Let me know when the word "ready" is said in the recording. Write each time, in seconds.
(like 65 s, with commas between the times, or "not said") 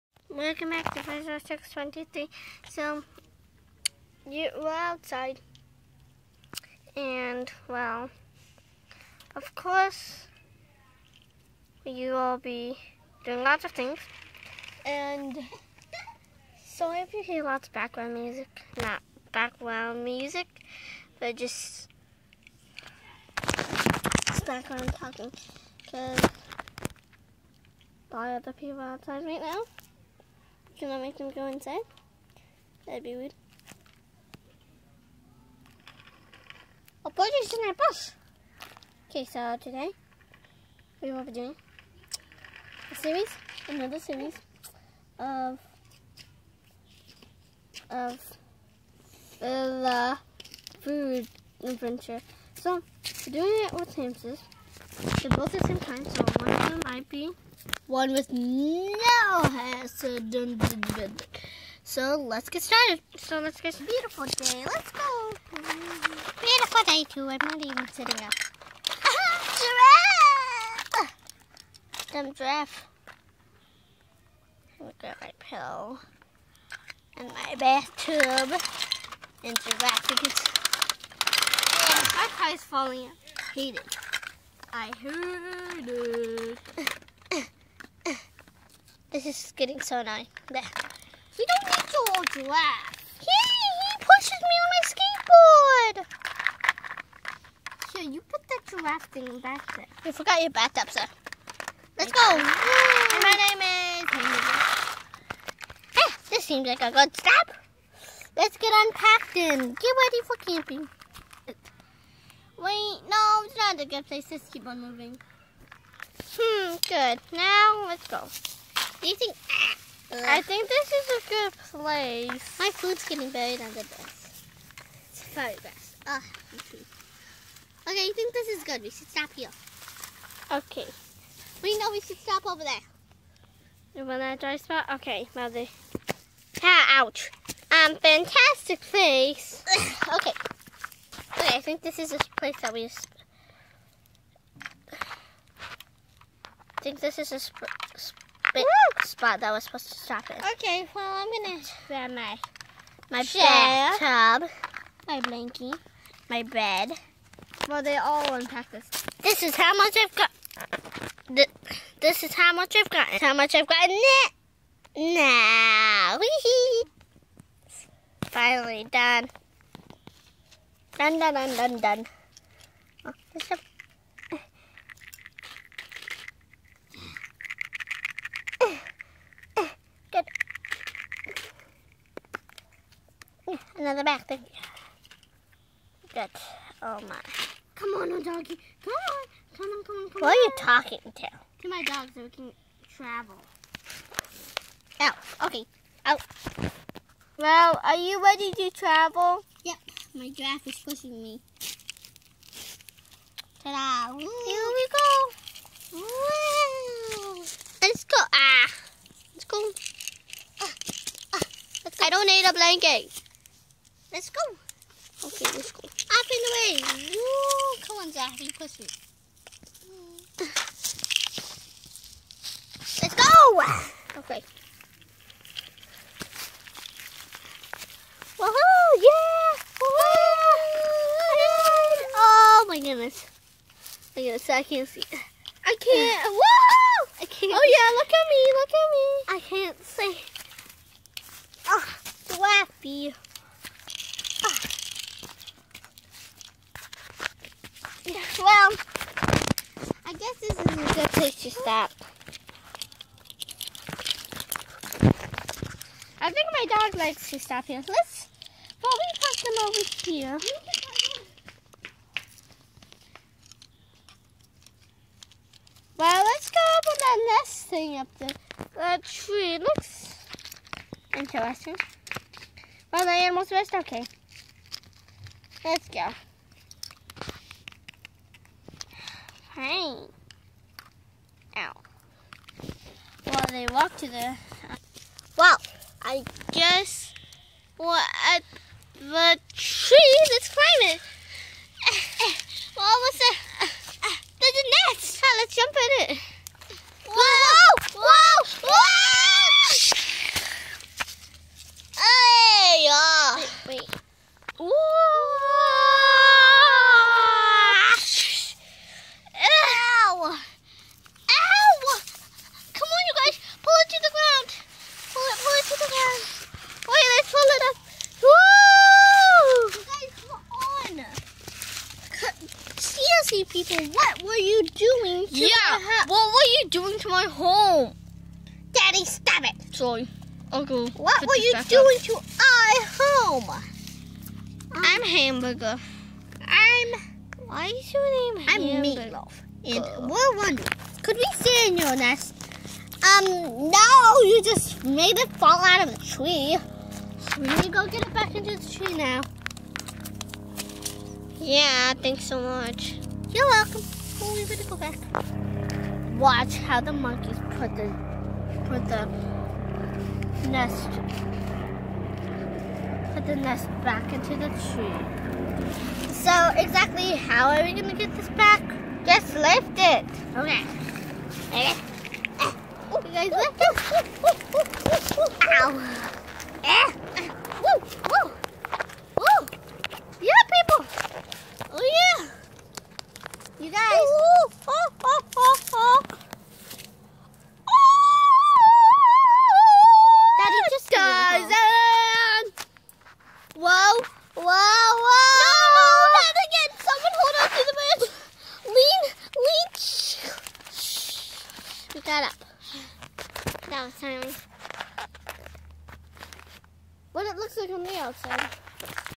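110 s, 198 s.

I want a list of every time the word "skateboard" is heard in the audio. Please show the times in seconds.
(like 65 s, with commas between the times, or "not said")
96 s.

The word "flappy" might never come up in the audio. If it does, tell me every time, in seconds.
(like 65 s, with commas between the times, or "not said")
242 s.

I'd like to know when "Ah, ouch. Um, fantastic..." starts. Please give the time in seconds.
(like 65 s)
136 s.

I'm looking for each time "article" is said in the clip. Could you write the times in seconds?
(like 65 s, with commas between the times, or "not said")
not said.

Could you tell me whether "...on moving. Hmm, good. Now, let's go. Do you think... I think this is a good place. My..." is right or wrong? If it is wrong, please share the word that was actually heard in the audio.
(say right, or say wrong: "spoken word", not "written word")
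right.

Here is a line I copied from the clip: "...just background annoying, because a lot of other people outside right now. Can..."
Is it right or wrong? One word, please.
wrong.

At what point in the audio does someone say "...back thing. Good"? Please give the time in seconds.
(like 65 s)
184 s.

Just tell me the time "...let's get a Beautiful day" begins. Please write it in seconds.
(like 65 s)
63 s.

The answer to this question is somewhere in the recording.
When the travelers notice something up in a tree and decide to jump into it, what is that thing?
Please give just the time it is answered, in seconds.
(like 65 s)
294 s.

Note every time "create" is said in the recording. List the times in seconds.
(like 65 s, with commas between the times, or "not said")
not said.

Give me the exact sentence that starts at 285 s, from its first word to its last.
Wow, I guess what at the tree that's climbing.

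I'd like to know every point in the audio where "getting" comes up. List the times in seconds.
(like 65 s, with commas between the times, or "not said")
89 s, 123 s.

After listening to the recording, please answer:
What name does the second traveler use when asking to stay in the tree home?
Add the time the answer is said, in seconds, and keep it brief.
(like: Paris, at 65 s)
Meatloaf, at 339 s.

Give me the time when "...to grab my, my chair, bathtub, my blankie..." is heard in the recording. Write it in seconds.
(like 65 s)
151 s.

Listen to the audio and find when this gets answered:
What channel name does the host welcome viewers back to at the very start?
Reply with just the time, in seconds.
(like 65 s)
1 s.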